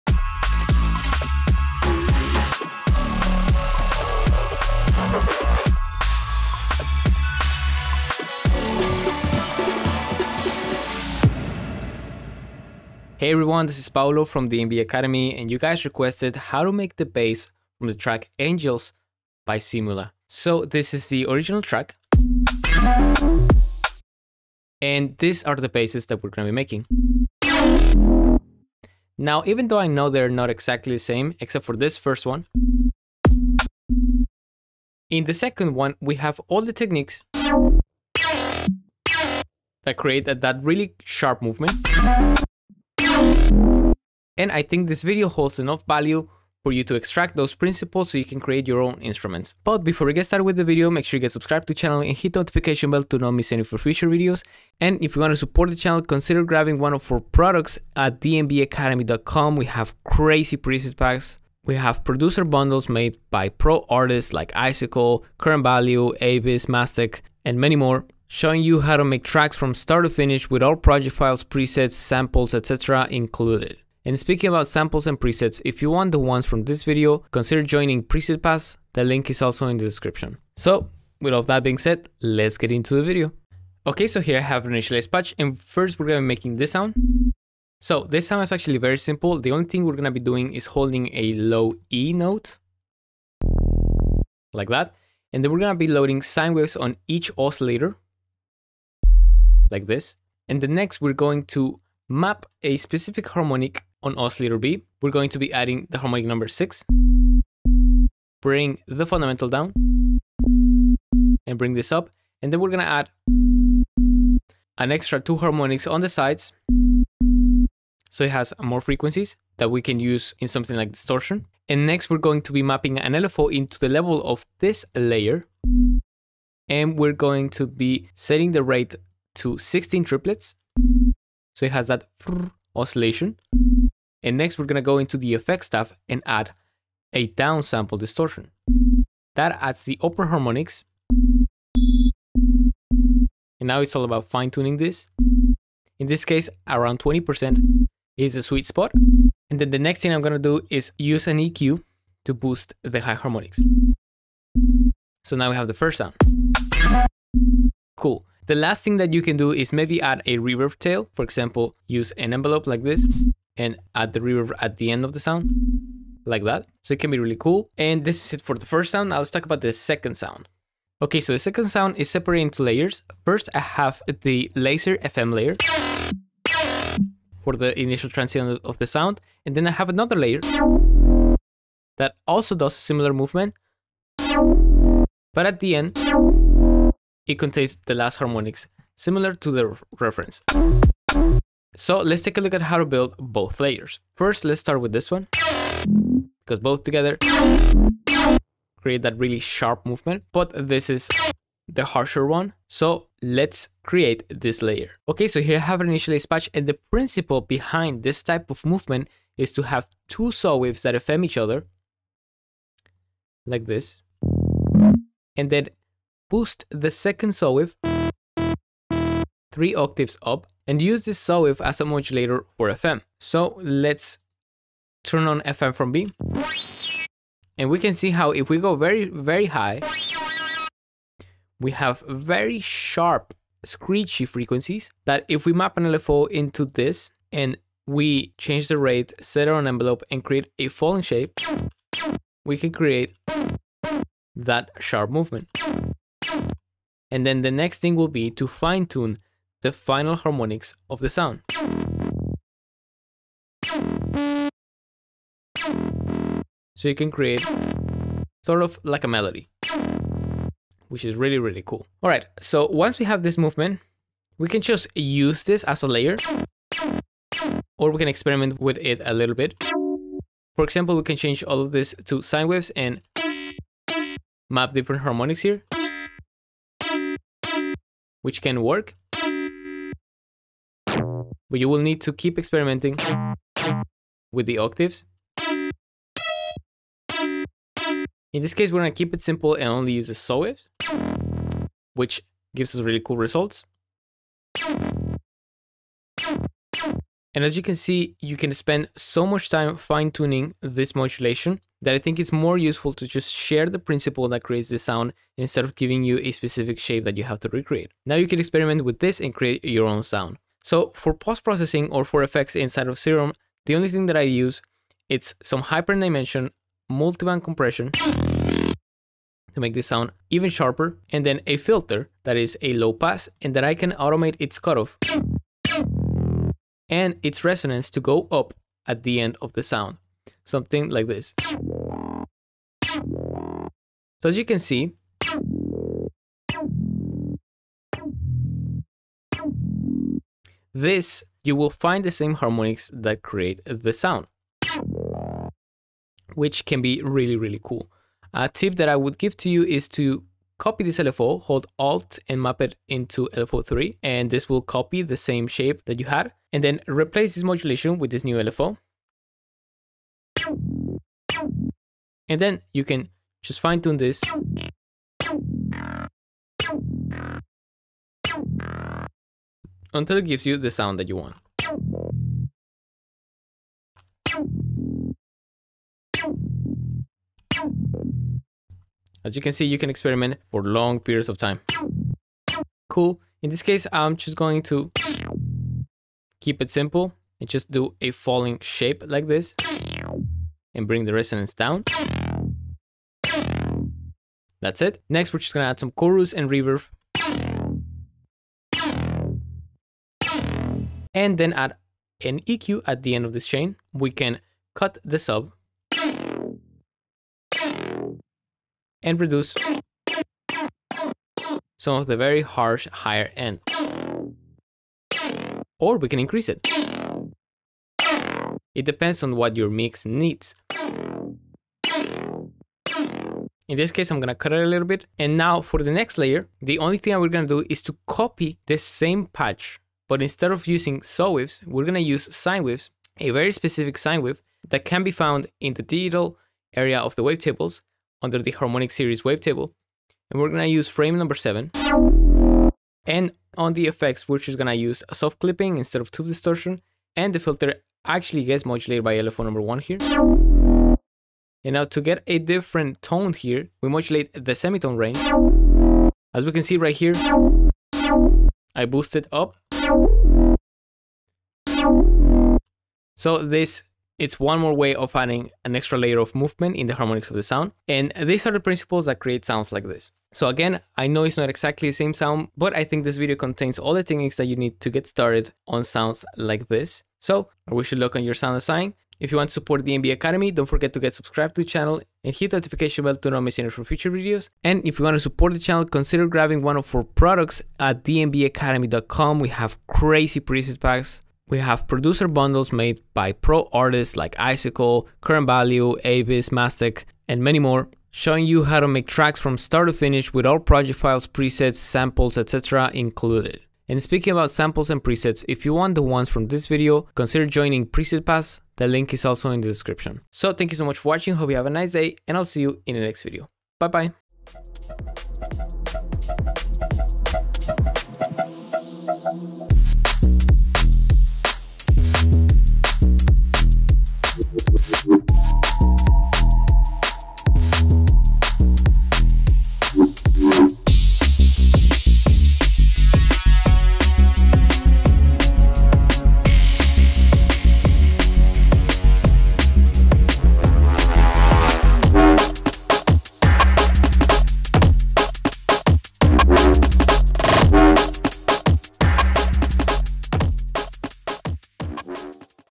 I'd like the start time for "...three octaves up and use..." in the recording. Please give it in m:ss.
3:39.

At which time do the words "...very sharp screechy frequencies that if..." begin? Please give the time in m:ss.
3:52.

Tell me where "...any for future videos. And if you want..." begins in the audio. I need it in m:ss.
8:03.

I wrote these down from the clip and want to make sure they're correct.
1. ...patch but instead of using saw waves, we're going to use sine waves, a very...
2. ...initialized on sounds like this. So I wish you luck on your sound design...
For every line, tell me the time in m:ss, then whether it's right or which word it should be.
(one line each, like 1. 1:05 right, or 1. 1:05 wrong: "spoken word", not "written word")
1. 7:09 right
2. 7:55 wrong: "started", not "initialized".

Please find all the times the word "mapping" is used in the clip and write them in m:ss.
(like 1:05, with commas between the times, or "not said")
2:02.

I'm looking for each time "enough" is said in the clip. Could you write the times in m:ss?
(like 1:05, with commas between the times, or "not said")
0:45.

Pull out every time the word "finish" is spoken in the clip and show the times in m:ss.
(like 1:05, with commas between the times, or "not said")
1:10, 8:19.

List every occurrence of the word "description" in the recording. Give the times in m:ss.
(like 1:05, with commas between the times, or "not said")
1:19, 8:29.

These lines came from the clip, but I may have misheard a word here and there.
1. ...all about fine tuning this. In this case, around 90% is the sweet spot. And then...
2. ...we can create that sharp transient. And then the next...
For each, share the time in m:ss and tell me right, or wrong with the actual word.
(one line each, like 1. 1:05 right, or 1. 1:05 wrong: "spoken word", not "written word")
1. 2:23 wrong: "20", not "90"
2. 4:02 wrong: "movement", not "transient".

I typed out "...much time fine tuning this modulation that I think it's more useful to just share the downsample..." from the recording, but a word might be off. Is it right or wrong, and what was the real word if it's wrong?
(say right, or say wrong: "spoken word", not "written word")
wrong: "principle", not "downsample".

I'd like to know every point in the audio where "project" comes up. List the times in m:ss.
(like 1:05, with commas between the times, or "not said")
1:10, 8:20.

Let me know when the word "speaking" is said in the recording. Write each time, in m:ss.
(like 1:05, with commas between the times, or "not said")
1:14, 8:24.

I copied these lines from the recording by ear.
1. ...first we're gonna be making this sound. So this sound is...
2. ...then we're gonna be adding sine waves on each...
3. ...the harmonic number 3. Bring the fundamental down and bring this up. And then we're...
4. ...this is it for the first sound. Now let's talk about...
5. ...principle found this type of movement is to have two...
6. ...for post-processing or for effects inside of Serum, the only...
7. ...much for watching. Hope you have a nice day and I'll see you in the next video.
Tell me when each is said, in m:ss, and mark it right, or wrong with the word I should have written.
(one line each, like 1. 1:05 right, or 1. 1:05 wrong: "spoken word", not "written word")
1. 1:25 right
2. 1:35 wrong: "loading", not "adding"
3. 1:45 wrong: "6", not "3"
4. 2:48 right
5. 3:26 wrong: "behind", not "found"
6. 5:10 right
7. 8:30 right.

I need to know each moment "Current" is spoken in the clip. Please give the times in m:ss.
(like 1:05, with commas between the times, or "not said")
1:05, 8:15.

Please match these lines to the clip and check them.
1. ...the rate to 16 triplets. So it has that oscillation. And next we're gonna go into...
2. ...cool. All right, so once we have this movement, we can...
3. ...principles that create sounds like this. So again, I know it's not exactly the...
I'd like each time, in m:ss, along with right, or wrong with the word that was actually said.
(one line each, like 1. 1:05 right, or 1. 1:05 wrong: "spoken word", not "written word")
1. 2:08 right
2. 4:21 right
3. 7:48 right.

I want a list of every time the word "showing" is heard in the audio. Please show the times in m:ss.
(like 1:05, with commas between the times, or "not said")
1:08, 8:18.